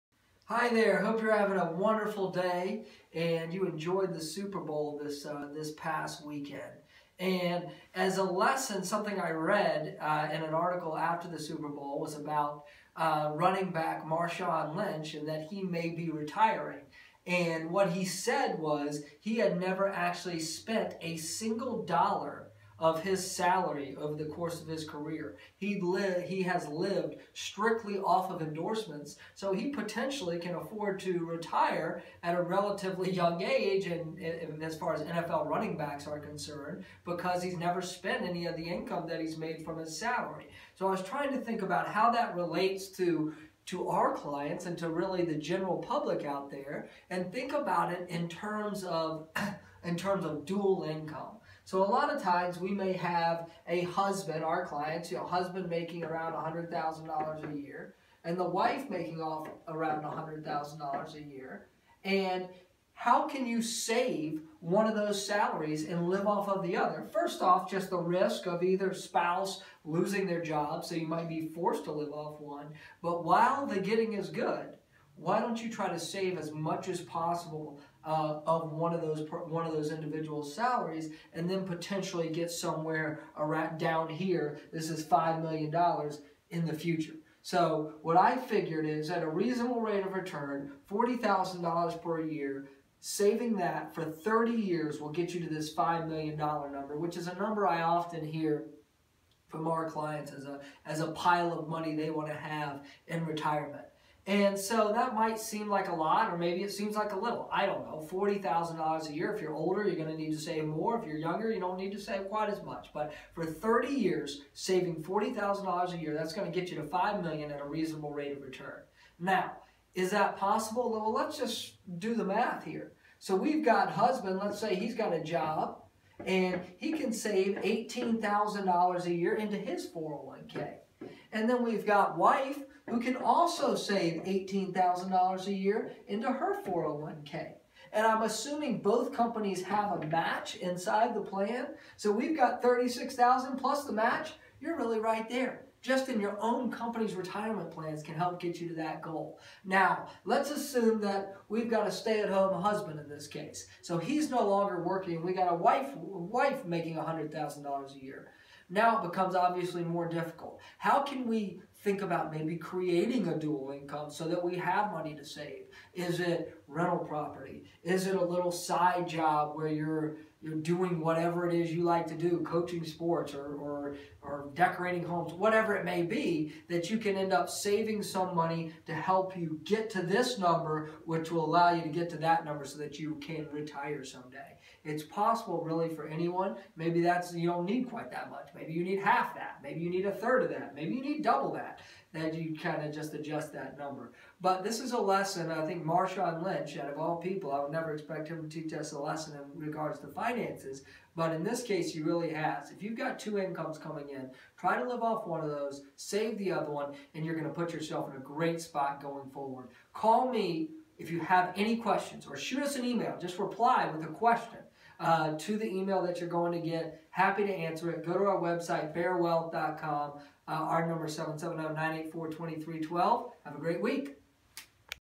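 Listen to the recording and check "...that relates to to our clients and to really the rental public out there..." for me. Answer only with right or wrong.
wrong.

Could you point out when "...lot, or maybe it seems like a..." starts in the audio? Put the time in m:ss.
1:45.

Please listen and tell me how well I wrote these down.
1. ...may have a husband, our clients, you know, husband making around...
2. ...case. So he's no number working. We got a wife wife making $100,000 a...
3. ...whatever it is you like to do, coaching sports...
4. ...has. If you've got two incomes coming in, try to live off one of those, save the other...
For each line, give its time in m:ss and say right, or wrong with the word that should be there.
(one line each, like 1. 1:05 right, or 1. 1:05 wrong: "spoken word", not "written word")
1. 0:52 right
2. 2:33 wrong: "longer", not "number"
3. 2:50 right
4. 3:22 right.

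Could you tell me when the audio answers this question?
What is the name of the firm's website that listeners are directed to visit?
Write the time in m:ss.
3:38.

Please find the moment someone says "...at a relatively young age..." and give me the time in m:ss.
0:32.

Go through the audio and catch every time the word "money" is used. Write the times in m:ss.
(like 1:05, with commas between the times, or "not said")
1:41, 2:44, 2:58.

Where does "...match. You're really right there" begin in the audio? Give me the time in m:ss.
2:23.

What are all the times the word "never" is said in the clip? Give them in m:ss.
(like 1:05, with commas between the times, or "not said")
0:19, 0:37, 3:17.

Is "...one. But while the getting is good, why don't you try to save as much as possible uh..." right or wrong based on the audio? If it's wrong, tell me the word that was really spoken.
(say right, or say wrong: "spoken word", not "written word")
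right.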